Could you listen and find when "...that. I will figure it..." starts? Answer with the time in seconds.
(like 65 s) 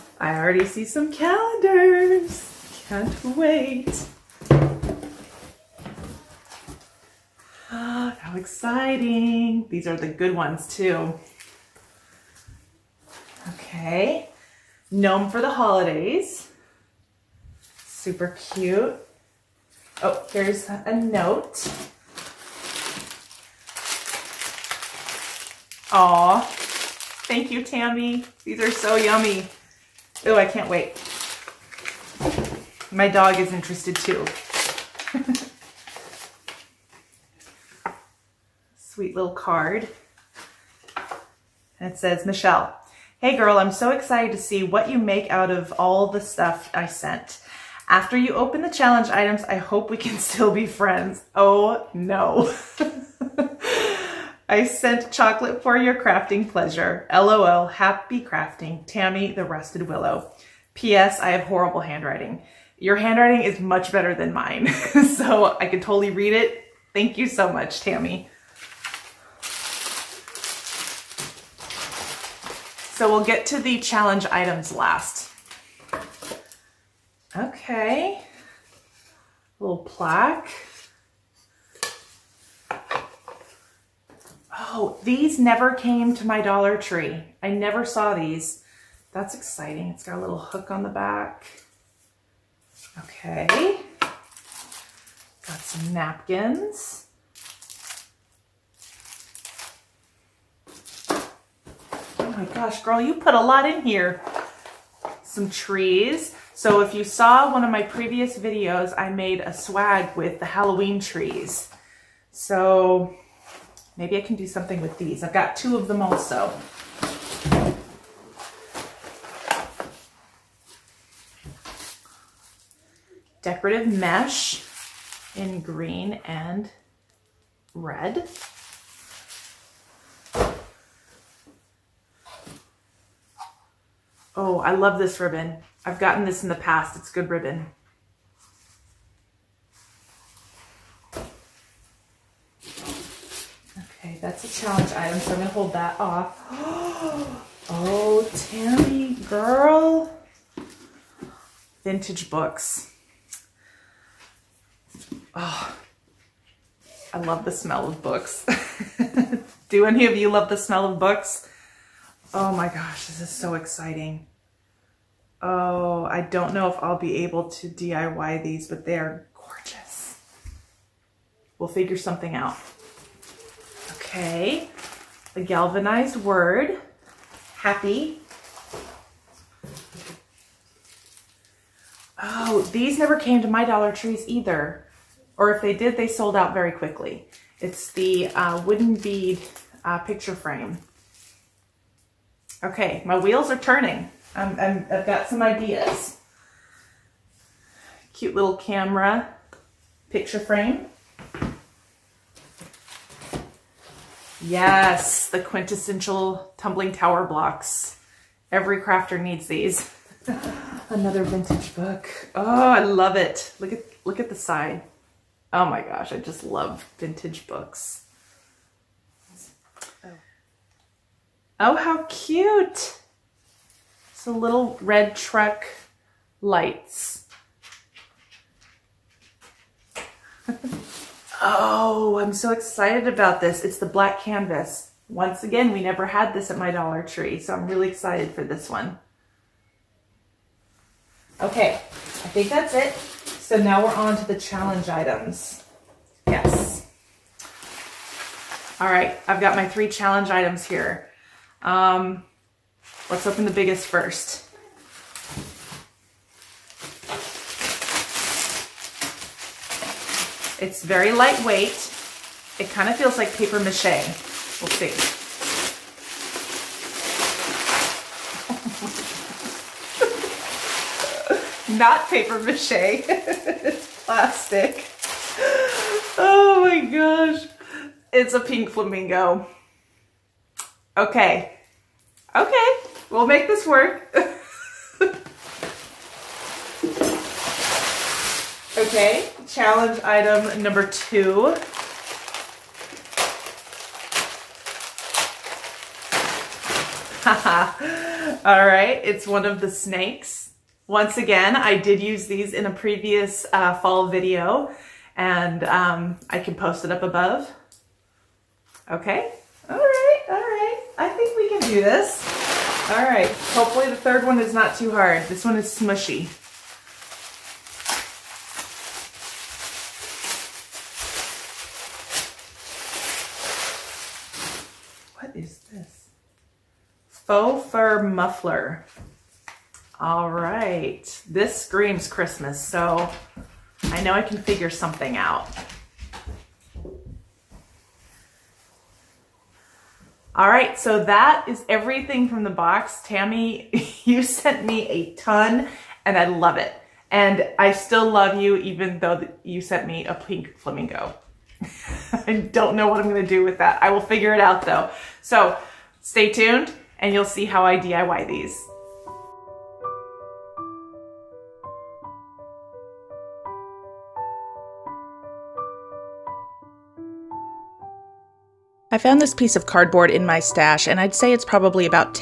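353 s.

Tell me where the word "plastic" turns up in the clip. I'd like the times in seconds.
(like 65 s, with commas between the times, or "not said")
274 s.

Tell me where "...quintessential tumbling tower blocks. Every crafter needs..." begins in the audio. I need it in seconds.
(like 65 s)
205 s.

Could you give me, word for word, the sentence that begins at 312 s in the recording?
All right, hopefully the third one is not too hard.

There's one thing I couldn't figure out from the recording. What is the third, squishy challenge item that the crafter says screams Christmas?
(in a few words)
Faux fur muffler.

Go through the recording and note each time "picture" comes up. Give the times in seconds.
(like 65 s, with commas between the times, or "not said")
189 s, 200 s.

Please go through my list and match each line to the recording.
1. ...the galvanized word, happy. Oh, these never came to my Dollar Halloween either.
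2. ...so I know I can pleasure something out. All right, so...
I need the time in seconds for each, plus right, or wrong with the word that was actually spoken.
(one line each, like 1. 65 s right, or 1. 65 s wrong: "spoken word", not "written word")
1. 175 s wrong: "Trees", not "Halloween"
2. 332 s wrong: "figure", not "pleasure".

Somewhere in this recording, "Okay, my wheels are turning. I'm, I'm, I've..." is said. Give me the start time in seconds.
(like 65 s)
192 s.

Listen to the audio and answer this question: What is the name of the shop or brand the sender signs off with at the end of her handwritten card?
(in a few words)
The Rusted Willow.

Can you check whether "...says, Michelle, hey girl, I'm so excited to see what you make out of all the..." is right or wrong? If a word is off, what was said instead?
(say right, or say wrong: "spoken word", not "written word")
right.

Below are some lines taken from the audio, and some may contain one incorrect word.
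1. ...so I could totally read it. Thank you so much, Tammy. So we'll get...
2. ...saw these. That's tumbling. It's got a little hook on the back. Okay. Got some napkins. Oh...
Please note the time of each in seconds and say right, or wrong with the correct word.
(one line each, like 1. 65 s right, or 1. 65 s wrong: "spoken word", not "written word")
1. 64 s right
2. 87 s wrong: "exciting", not "tumbling".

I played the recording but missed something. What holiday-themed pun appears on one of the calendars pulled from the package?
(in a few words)
Gnome for the holidays.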